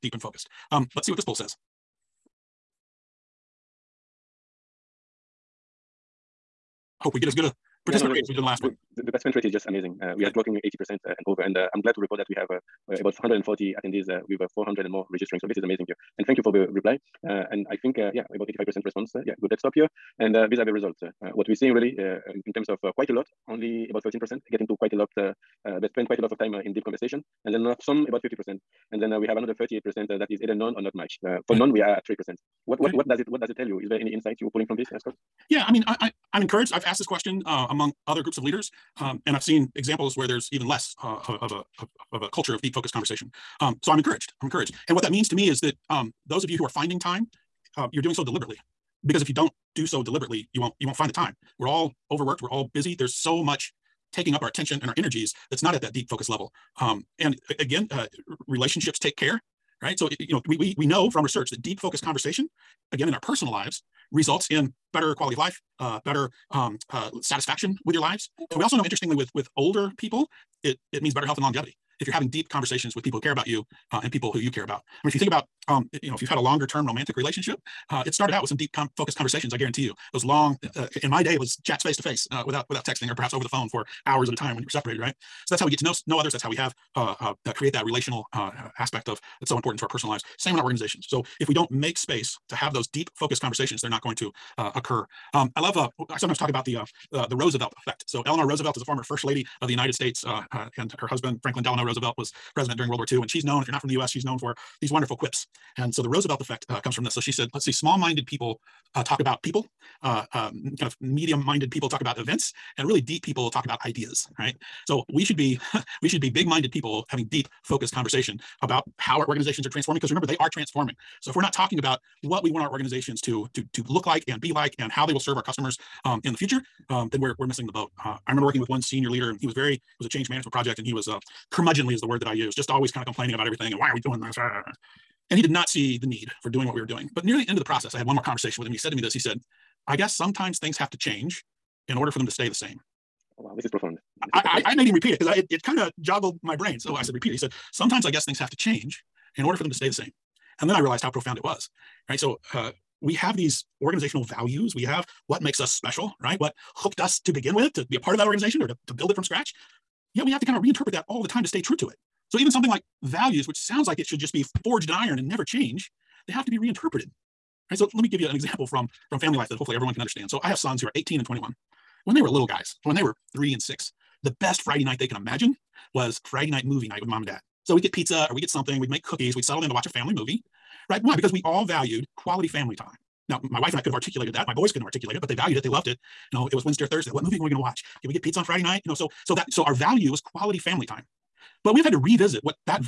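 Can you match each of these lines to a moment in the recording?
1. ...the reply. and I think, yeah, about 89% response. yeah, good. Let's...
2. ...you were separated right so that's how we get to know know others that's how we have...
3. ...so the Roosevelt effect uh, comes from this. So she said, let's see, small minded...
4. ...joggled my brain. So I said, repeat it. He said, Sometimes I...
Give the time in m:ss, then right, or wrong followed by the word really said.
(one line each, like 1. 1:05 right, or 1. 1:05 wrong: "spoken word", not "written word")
1. 0:16 wrong: "85", not "89"
2. 1:24 right
3. 1:45 right
4. 2:26 right.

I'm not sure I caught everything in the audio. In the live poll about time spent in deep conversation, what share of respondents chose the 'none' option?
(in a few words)
3%.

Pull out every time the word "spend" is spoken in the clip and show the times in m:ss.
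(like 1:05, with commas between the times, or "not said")
0:25.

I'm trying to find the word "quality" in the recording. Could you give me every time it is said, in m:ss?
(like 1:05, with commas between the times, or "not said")
1:05, 3:02, 3:10.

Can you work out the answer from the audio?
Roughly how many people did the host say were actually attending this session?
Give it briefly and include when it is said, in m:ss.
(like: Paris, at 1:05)
140, at 0:13.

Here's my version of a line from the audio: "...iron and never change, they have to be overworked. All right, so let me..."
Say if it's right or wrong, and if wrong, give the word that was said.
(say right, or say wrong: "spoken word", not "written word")
wrong: "reinterpreted", not "overworked".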